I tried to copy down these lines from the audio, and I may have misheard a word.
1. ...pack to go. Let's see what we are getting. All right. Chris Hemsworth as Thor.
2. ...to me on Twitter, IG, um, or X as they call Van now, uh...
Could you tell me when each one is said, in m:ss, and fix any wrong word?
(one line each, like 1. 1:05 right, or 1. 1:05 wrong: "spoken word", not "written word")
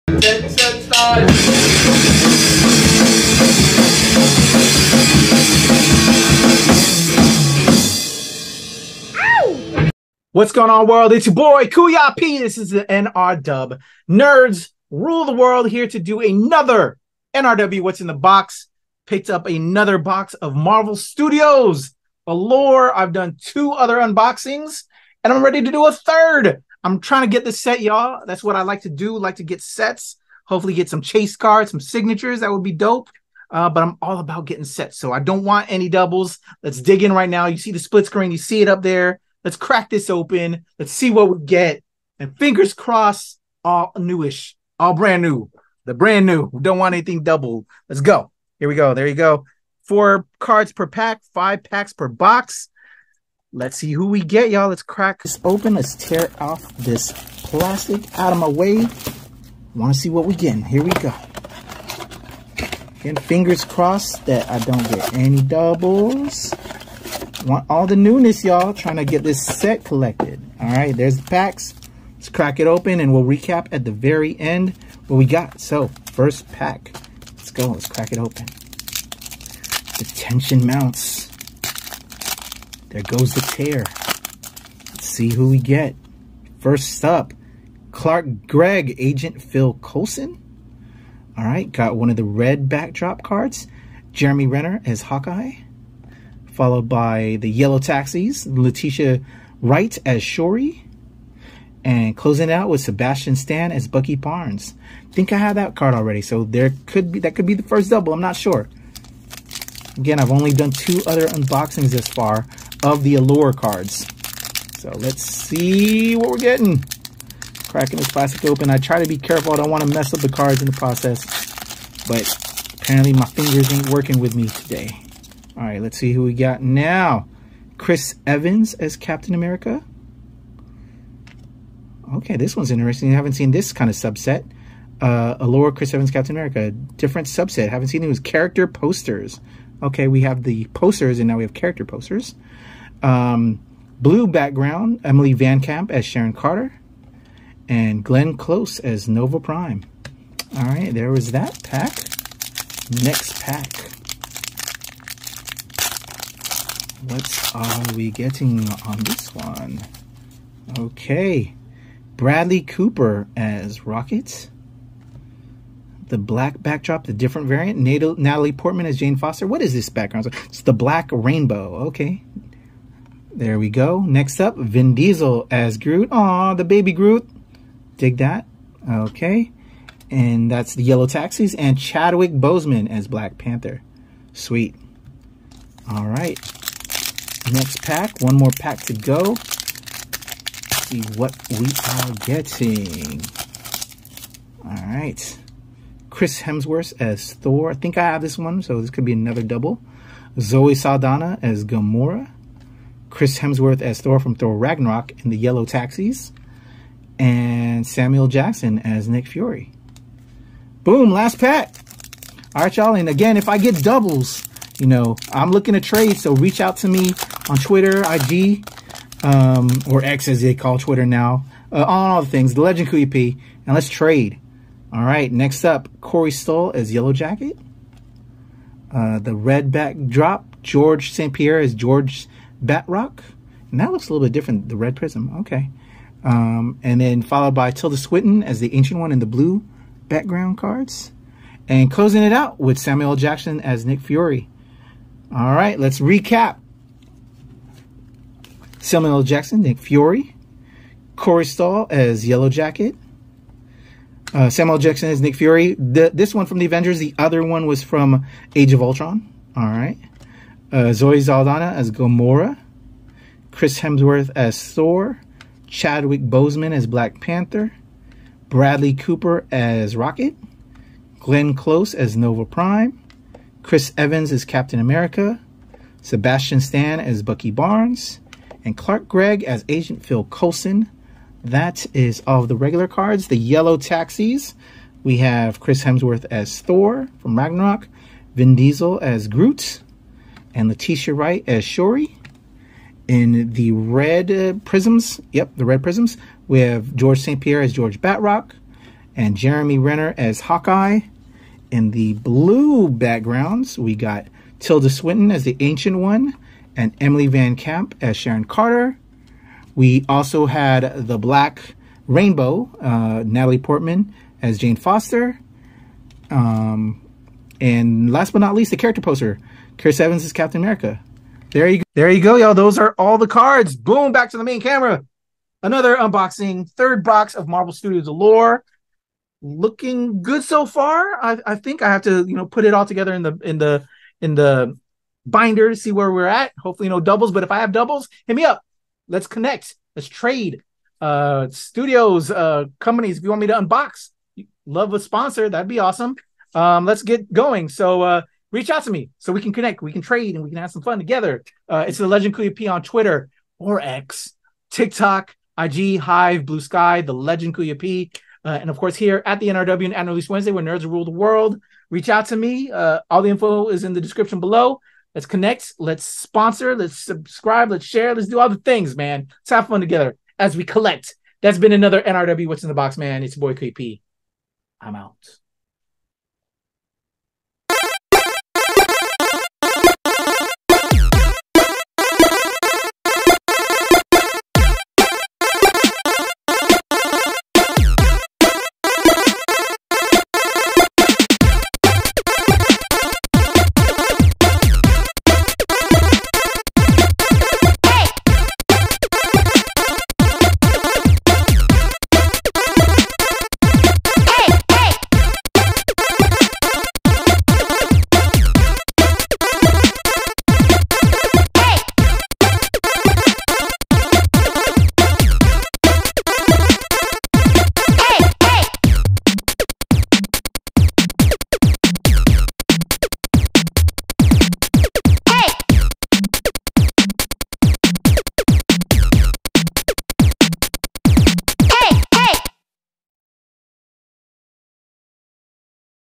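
1. 3:08 right
2. 3:36 wrong: "Twitter", not "Van".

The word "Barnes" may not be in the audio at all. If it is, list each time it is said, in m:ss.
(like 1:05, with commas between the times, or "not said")
1:44, 4:37.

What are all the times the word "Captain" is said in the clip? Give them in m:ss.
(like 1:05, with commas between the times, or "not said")
2:08, 2:16, 4:34, 5:20.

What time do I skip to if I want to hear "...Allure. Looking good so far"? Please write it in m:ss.
5:28.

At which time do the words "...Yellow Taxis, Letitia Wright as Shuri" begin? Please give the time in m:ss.
1:37.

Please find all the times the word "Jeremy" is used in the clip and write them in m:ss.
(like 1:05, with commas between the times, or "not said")
1:34, 4:59.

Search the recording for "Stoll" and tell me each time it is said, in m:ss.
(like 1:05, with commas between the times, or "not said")
3:46, 4:11.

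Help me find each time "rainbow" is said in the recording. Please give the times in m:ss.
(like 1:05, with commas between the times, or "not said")
2:51, 5:12.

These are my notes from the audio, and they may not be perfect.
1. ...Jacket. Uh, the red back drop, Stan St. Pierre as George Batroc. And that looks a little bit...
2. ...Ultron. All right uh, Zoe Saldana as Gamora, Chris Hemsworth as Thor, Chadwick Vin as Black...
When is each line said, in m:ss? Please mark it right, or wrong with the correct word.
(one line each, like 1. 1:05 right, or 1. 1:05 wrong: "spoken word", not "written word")
1. 3:47 wrong: "George", not "Stan"
2. 4:18 wrong: "Boseman", not "Vin".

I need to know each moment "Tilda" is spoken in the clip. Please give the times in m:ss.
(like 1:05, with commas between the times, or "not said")
3:57, 5:04.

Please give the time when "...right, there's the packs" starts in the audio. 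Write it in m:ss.
1:10.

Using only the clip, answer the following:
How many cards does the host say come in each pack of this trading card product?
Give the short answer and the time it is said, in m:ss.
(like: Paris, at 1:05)
4, at 0:49.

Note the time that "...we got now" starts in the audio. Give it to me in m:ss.
2:06.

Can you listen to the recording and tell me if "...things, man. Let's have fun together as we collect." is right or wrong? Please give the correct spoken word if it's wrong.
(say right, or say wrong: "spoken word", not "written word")
right.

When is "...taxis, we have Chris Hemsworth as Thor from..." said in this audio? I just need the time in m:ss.
4:43.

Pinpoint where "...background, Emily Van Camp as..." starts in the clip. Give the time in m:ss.
2:24.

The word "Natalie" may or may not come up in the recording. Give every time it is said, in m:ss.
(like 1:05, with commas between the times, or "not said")
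2:47, 5:13.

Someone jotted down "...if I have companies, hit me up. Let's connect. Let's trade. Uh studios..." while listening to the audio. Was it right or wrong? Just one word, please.
wrong.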